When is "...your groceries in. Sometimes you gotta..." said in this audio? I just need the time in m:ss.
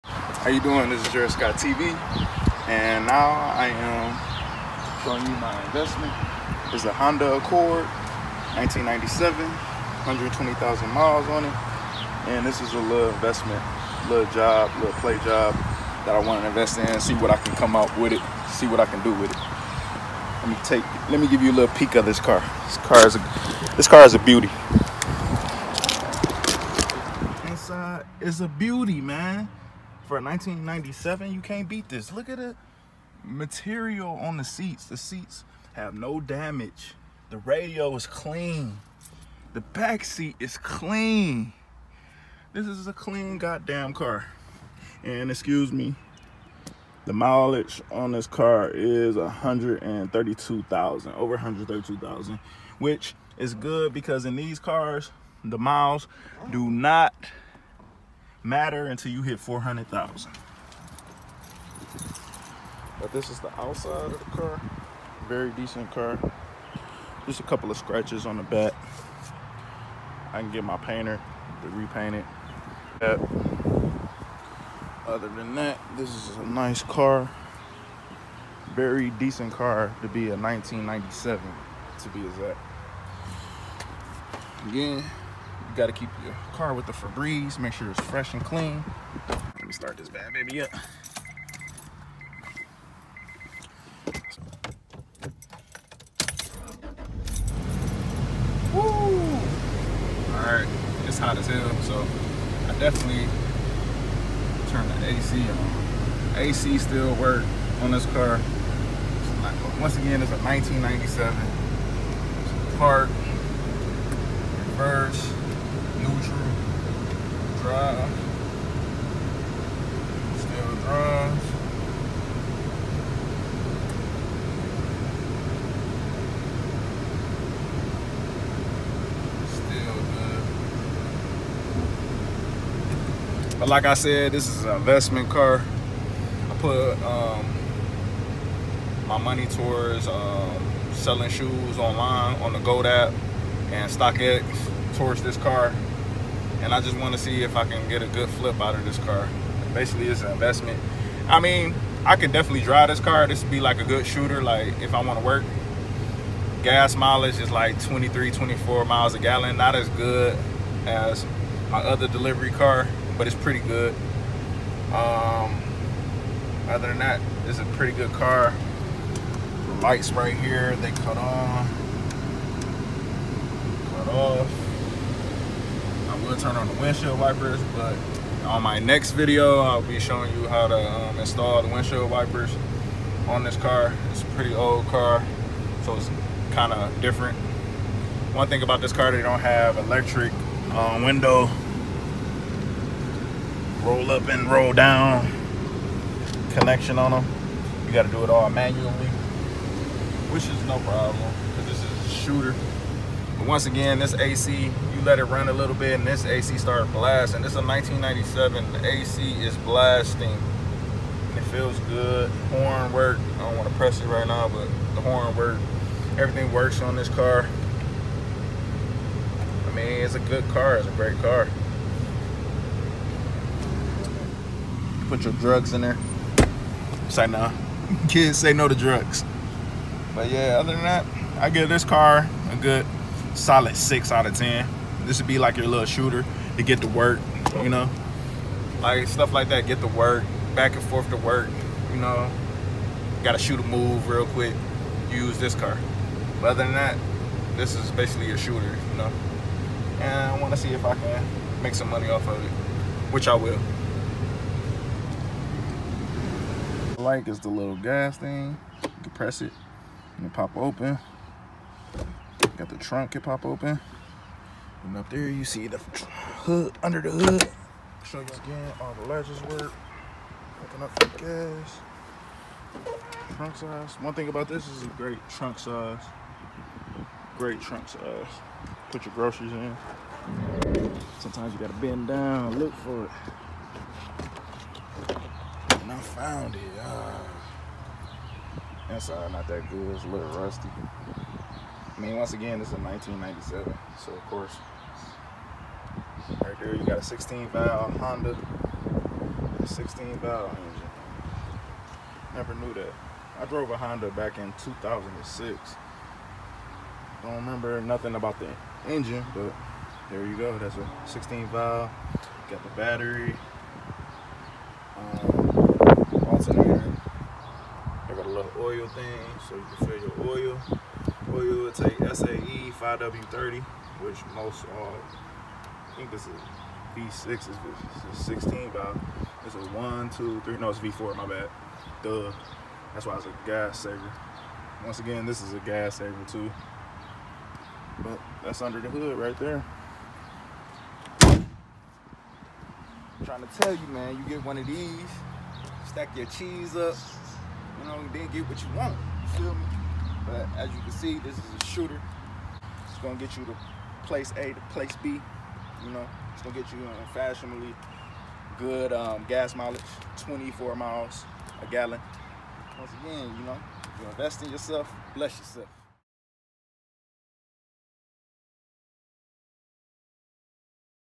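4:39.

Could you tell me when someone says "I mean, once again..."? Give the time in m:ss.
4:50.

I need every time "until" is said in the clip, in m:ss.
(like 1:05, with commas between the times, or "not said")
0:58.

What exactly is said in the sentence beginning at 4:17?
like is the little gas thing.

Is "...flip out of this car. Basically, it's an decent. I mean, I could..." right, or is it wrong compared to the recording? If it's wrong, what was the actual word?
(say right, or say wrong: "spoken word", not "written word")
wrong: "investment", not "decent".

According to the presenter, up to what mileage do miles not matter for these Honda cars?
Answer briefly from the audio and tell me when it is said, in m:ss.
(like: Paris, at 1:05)
400,000, at 0:59.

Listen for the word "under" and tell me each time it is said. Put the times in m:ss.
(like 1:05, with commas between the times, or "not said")
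4:26, 5:38.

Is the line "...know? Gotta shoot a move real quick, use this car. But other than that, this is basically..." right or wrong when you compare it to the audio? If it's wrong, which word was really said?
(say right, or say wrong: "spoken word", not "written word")
right.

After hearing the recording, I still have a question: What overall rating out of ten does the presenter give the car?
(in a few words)
6.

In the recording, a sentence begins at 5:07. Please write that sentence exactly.
Don't remember nothing about the engine, but there you go.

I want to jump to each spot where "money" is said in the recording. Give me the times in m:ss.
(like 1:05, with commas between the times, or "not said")
2:19, 4:11.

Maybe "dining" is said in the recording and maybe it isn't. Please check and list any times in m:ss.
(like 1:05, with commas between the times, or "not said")
not said.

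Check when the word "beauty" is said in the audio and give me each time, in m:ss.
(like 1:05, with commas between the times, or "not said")
0:24, 0:28.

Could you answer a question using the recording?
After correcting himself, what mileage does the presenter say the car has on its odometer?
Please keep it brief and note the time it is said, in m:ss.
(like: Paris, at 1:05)
over 132,000, at 0:51.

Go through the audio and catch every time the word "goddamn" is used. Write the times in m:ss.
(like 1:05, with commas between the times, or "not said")
0:43.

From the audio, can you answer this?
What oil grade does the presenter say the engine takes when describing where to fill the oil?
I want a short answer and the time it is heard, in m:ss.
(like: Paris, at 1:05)
SAE 5W30, at 5:21.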